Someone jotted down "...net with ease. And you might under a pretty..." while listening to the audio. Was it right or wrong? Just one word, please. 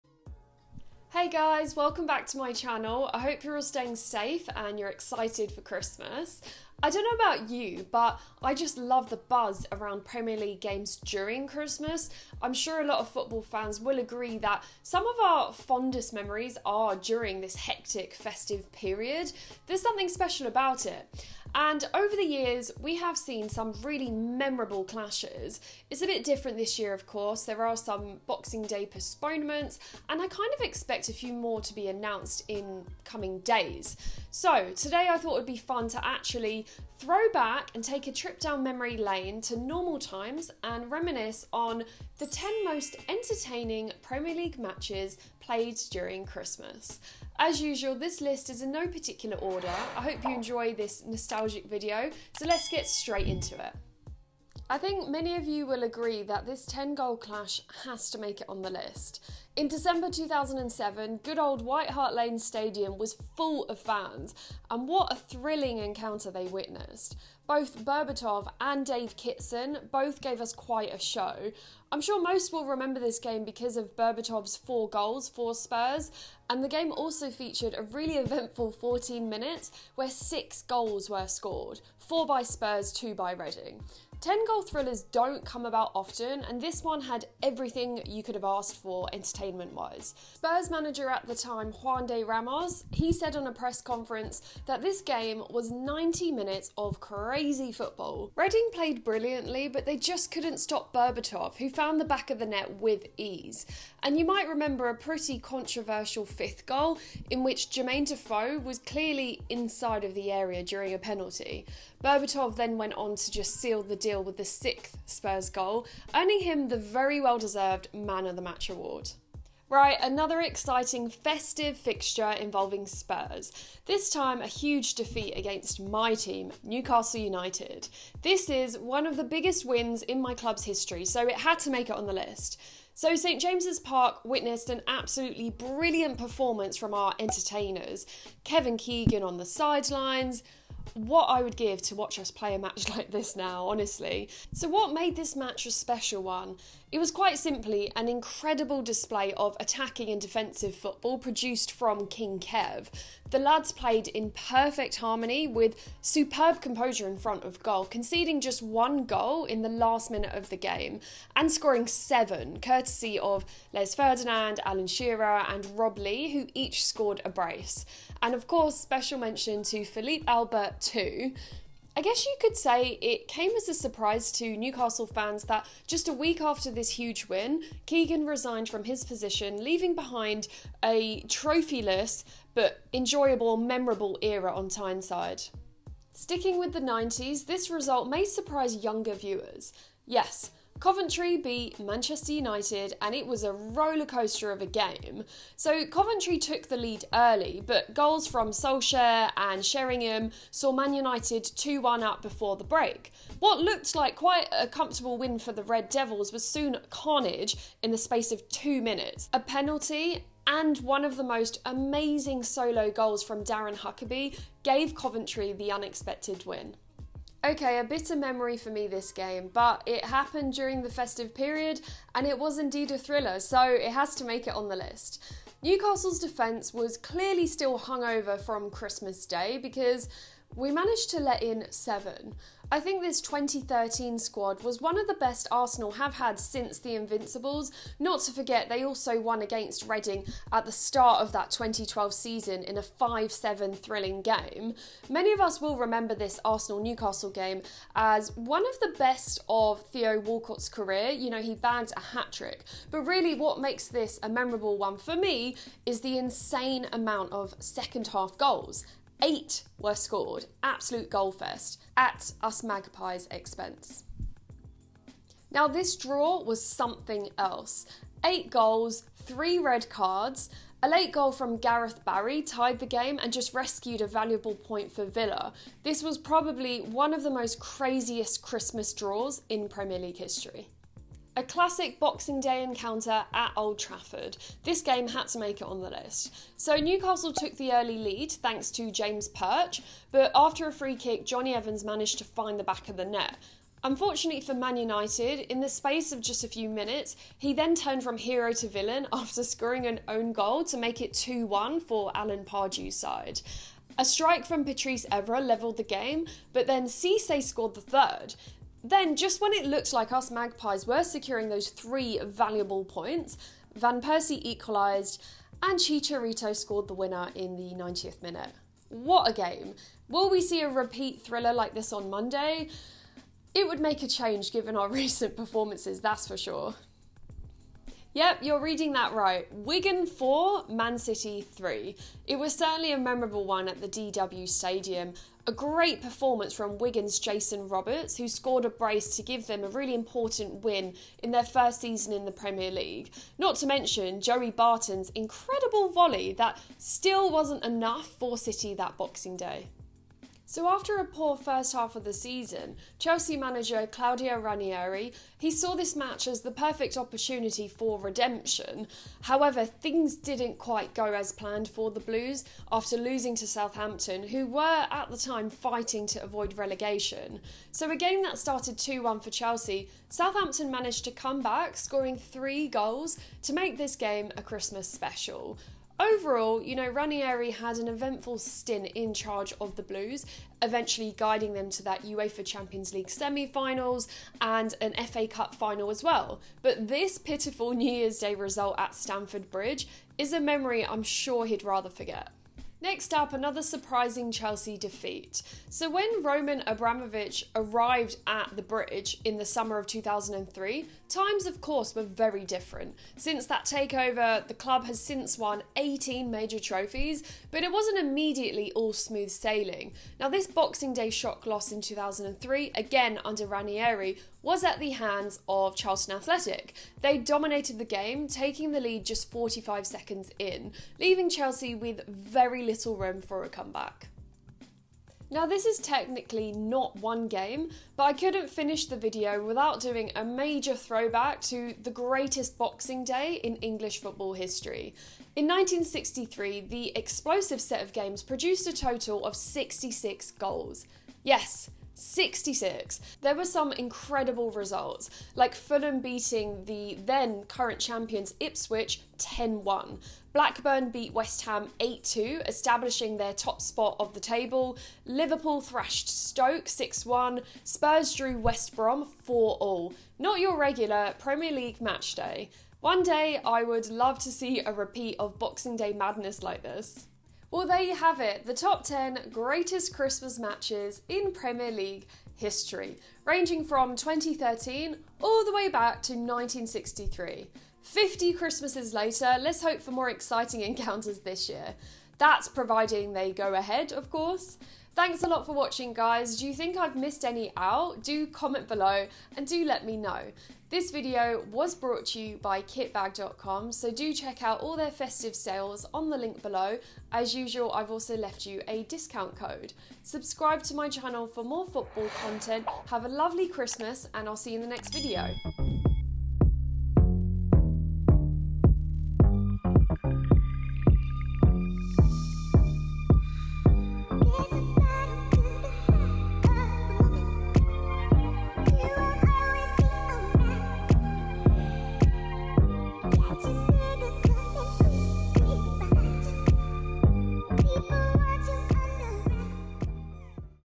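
wrong.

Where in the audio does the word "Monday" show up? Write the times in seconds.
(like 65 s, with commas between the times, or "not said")
322 s.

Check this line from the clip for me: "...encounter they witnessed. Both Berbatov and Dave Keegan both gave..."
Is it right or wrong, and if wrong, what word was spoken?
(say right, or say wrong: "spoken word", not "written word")
wrong: "Kitson", not "Keegan".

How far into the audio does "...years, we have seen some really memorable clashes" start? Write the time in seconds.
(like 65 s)
22 s.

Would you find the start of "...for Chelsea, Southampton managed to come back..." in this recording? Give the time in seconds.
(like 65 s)
369 s.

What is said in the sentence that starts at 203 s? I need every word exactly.
What looked like quite a comfortable win for the Red Devils was soon carnage in the space of two minutes.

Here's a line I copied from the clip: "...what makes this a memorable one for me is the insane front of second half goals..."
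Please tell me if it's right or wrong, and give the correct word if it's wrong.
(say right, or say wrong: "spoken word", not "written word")
wrong: "amount", not "front".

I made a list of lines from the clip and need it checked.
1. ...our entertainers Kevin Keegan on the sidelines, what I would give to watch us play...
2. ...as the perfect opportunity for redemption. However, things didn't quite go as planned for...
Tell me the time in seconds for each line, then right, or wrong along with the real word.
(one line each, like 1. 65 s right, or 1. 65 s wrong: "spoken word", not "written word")
1. 136 s right
2. 356 s right.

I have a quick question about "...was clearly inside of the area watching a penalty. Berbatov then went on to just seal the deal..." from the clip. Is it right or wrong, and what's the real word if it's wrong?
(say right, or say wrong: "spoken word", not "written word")
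wrong: "during", not "watching".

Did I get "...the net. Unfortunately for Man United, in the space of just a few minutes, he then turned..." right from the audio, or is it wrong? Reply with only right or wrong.
right.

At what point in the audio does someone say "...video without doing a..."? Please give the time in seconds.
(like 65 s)
428 s.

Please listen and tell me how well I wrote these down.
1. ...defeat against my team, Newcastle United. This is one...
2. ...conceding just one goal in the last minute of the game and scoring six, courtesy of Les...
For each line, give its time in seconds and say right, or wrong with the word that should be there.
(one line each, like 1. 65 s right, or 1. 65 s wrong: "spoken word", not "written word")
1. 124 s right
2. 157 s wrong: "seven", not "six".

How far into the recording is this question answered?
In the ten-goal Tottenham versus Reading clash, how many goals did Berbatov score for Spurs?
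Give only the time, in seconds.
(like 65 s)
74 s.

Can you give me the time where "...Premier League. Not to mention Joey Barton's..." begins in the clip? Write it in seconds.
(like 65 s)
342 s.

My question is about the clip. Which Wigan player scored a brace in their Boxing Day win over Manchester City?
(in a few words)
Jason Roberts.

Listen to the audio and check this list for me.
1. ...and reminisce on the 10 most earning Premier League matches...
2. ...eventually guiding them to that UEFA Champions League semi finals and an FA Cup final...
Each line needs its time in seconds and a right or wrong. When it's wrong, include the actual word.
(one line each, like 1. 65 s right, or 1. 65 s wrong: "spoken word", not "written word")
1. 40 s wrong: "entertaining", not "earning"
2. 380 s right.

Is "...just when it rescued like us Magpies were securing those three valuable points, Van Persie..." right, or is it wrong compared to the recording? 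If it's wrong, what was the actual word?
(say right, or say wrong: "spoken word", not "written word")
wrong: "looked", not "rescued".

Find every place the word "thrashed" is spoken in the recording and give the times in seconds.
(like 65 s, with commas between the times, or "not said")
455 s.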